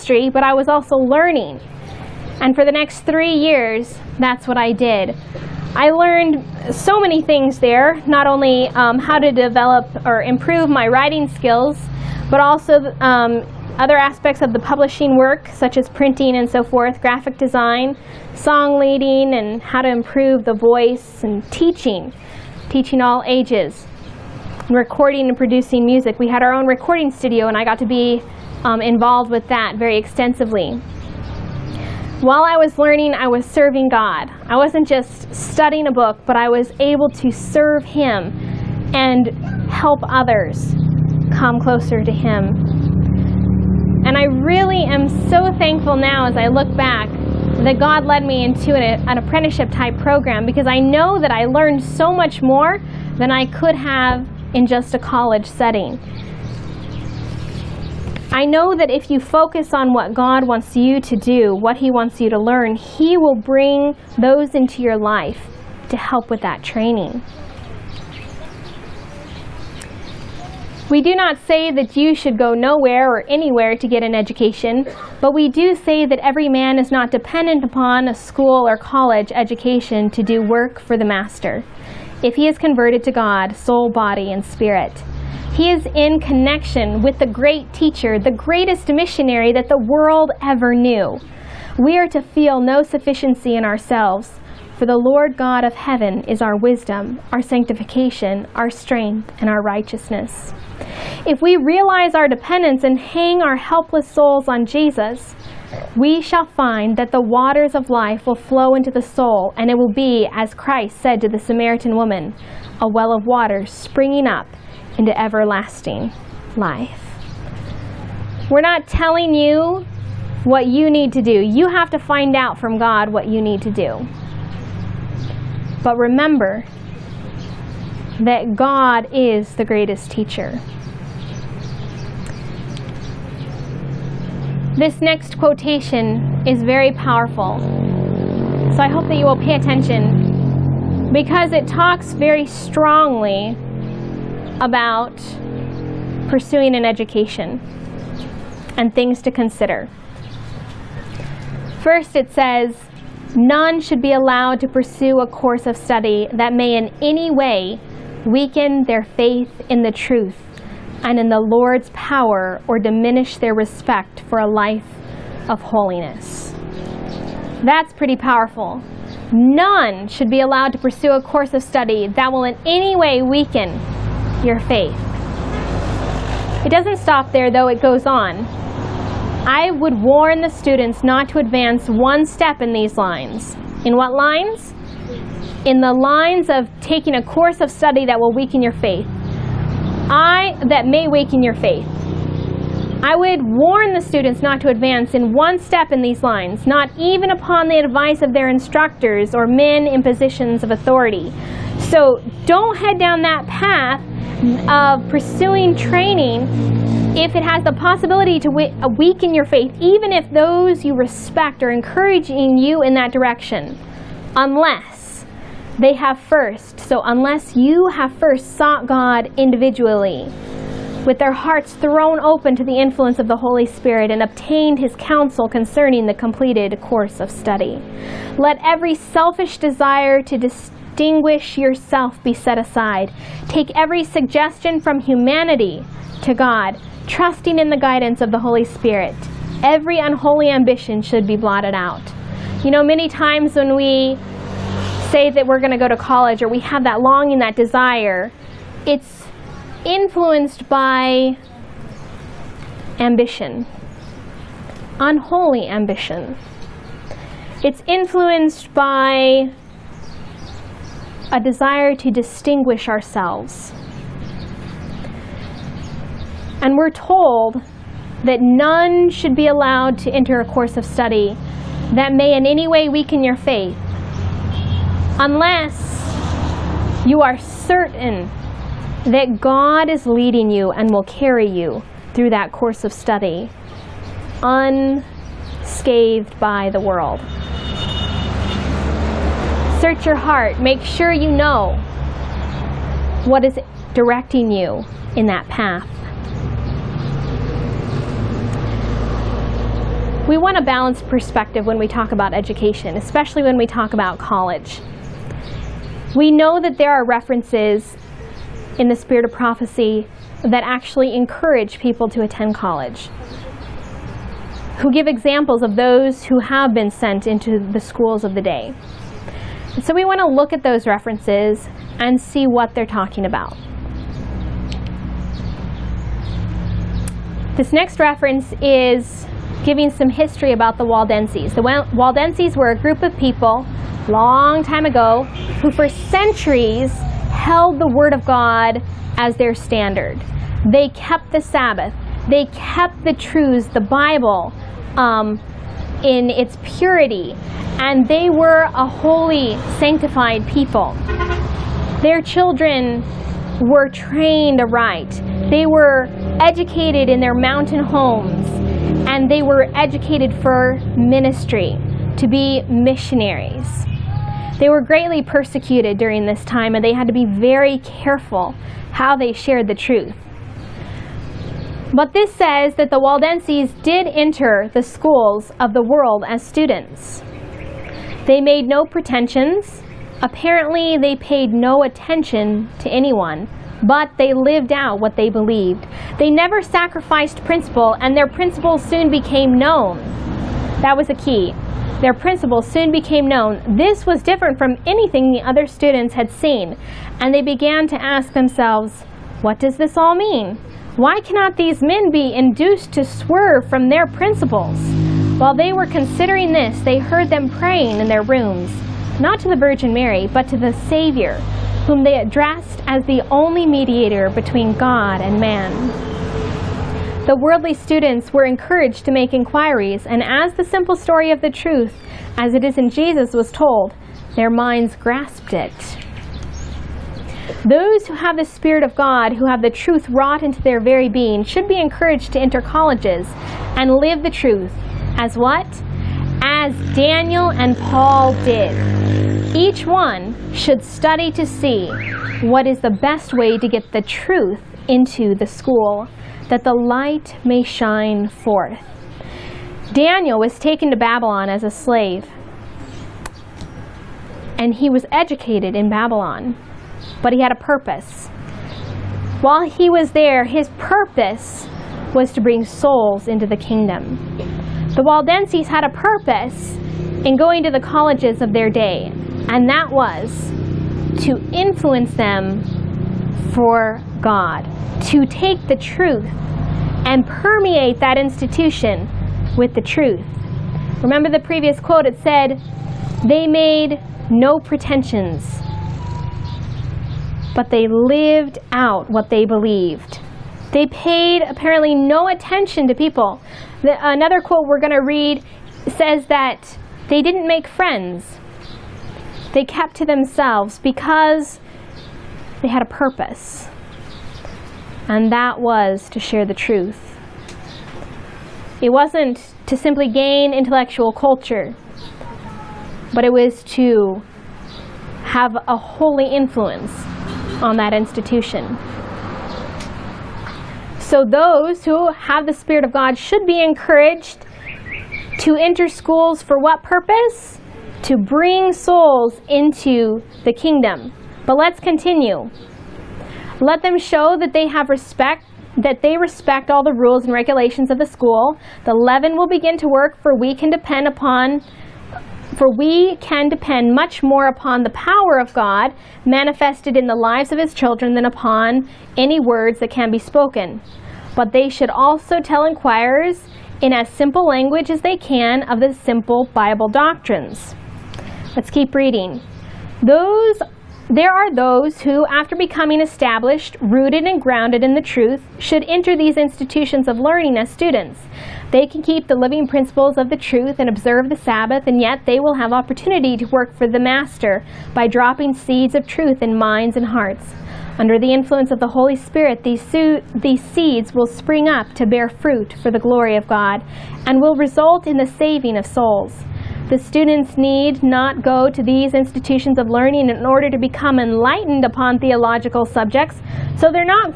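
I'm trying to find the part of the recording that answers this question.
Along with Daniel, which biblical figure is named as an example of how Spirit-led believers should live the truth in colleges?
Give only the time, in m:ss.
7:17.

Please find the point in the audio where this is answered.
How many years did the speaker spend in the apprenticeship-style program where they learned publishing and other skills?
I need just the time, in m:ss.
0:03.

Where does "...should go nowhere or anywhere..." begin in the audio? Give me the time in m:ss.
1:12.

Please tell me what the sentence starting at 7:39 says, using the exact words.
While he was there, his purpose was to bring souls into the kingdom.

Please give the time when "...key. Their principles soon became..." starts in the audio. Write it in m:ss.
6:31.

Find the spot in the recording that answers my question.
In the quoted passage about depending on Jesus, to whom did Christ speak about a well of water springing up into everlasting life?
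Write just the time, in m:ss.
1:51.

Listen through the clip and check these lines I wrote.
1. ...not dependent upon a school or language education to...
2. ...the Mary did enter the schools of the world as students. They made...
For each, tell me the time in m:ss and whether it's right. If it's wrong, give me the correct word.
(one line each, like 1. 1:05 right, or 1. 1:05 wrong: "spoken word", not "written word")
1. 1:16 wrong: "college", not "language"
2. 6:12 wrong: "Waldenses", not "Mary".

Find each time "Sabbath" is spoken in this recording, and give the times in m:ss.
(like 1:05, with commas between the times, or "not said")
5:41, 9:31.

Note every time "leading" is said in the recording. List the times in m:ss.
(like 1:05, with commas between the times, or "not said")
0:18, 4:40.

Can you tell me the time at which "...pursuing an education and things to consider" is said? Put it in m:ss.
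2:26.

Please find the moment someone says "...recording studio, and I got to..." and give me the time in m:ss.
0:26.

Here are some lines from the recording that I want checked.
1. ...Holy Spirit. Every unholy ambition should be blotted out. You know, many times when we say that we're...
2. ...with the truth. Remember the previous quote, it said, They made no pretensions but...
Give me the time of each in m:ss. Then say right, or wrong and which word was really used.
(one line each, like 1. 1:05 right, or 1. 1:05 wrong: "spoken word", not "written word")
1. 3:58 right
2. 7:59 right.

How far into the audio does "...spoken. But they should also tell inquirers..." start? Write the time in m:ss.
9:10.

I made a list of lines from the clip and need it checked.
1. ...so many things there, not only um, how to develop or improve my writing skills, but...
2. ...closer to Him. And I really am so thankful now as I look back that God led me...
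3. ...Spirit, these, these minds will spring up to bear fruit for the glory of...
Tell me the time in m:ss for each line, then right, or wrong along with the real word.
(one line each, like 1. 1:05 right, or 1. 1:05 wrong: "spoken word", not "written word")
1. 0:06 right
2. 0:41 right
3. 9:39 wrong: "seeds", not "minds".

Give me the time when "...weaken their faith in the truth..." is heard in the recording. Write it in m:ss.
2:38.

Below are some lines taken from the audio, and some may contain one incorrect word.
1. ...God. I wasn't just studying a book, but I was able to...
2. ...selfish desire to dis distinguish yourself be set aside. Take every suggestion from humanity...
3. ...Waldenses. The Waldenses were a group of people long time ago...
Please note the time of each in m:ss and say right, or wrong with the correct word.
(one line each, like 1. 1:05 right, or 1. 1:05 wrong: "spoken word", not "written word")
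1. 0:33 right
2. 3:48 right
3. 5:30 right.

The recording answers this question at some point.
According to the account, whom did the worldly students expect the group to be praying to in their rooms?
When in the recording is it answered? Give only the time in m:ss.
6:49.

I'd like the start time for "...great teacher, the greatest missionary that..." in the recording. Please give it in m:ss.
1:27.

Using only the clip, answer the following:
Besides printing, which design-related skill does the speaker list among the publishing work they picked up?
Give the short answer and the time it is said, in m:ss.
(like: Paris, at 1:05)
Graphic design, at 0:17.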